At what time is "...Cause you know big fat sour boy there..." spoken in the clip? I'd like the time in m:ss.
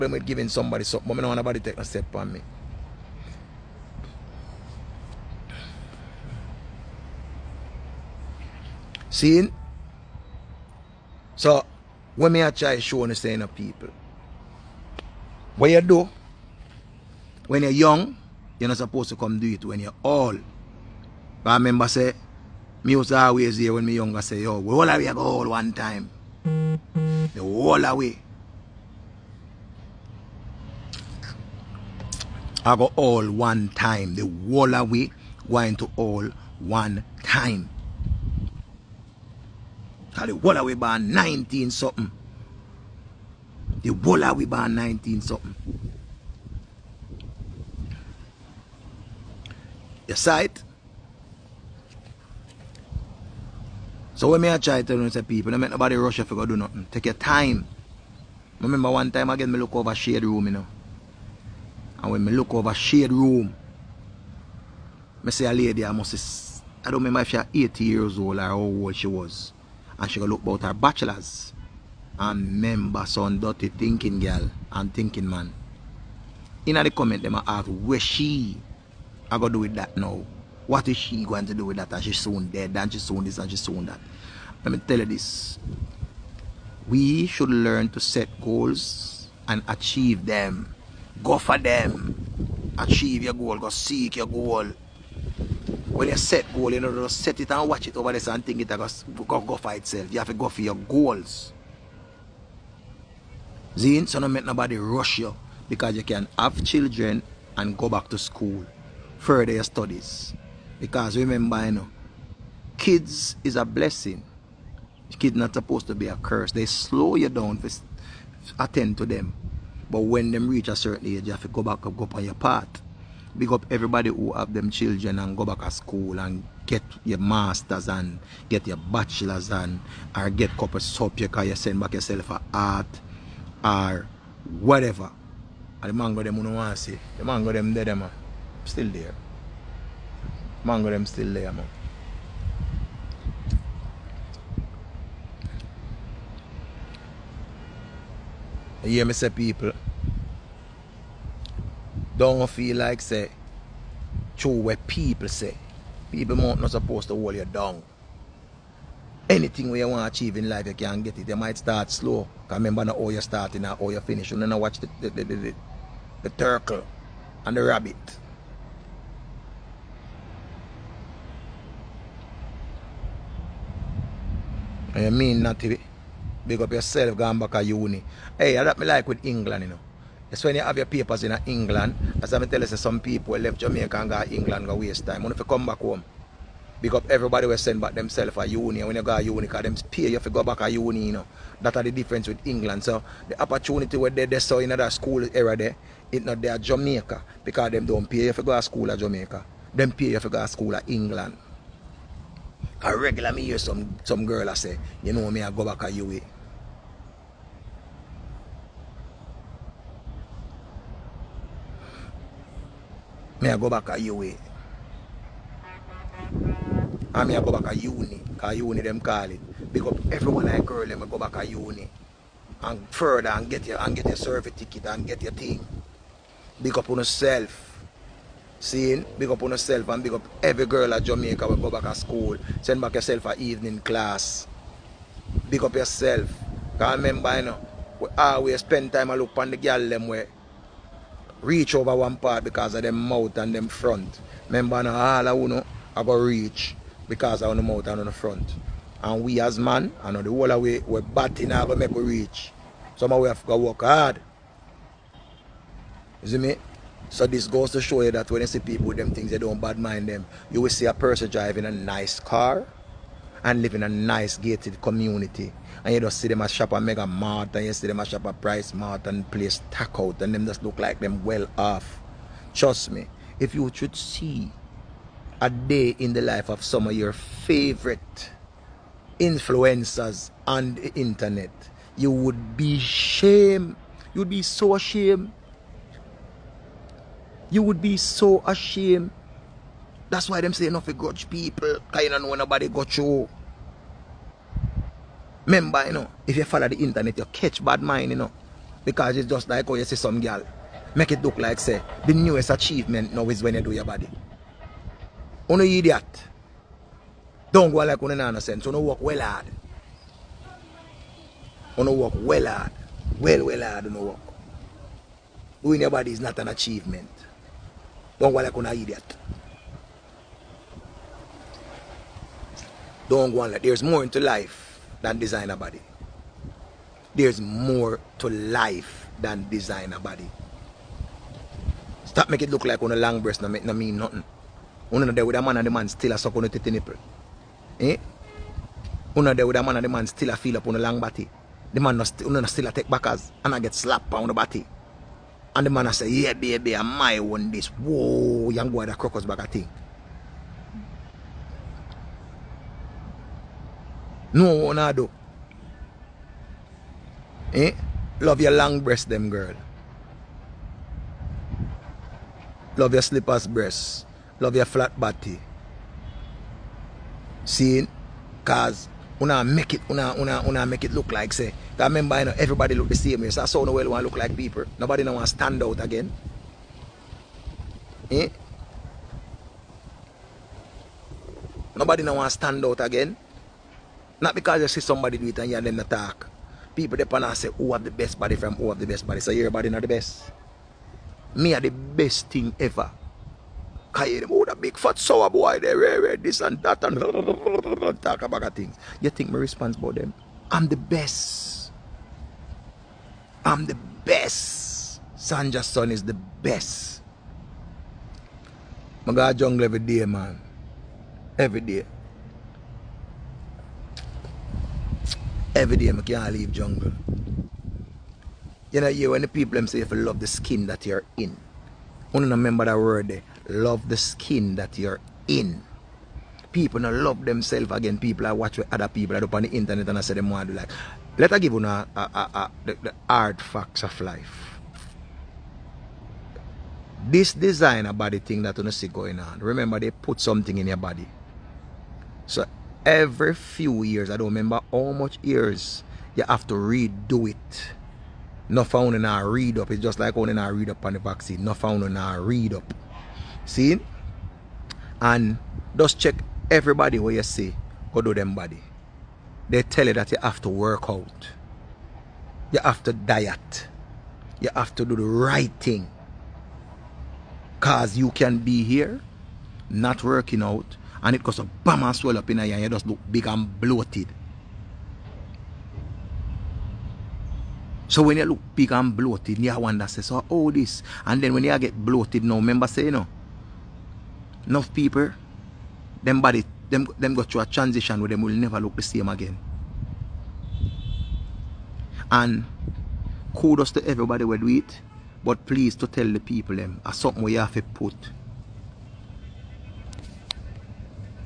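6:33.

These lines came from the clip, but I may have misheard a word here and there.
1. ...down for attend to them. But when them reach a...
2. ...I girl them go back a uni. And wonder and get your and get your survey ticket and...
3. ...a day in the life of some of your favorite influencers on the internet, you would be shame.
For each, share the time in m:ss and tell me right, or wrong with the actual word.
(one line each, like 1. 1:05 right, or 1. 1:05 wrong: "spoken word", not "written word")
1. 1:57 right
2. 3:40 wrong: "further", not "wonder"
3. 4:35 right.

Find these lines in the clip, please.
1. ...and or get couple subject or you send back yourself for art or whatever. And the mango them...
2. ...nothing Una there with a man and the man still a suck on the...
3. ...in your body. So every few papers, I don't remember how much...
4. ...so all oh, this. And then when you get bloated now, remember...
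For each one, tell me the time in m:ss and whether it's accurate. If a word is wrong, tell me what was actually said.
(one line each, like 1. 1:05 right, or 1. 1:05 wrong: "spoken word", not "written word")
1. 2:09 right
2. 5:33 right
3. 7:20 wrong: "years", not "papers"
4. 8:00 right.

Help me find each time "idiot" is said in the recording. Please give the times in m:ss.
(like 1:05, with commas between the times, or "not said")
5:05, 5:18.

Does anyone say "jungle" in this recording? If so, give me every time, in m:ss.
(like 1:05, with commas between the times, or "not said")
6:49, 6:56.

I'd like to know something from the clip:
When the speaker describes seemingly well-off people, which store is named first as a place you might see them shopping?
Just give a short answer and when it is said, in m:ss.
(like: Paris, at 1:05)
Mega Mart, at 4:26.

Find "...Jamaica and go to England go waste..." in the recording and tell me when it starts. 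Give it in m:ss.
3:03.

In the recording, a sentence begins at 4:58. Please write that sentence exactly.
Because it's just like how you see some girl.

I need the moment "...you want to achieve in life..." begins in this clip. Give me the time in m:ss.
2:39.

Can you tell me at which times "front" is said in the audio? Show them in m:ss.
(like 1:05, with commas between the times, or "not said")
4:03, 4:08.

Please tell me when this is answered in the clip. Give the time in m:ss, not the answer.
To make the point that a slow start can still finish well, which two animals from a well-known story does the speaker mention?
2:46.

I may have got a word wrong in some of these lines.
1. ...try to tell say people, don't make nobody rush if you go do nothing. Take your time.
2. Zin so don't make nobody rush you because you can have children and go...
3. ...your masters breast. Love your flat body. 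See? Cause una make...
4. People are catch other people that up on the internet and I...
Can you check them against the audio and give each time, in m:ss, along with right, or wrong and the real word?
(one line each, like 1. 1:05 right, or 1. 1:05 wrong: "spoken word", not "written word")
1. 0:54 right
2. 1:43 right
3. 6:02 wrong: "slippers", not "masters"
4. 7:07 wrong: "watch", not "catch".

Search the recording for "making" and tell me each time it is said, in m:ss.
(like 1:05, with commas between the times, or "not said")
5:32.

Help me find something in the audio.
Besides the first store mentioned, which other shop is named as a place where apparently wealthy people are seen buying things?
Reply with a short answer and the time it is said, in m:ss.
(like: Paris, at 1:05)
Price Mart, at 4:28.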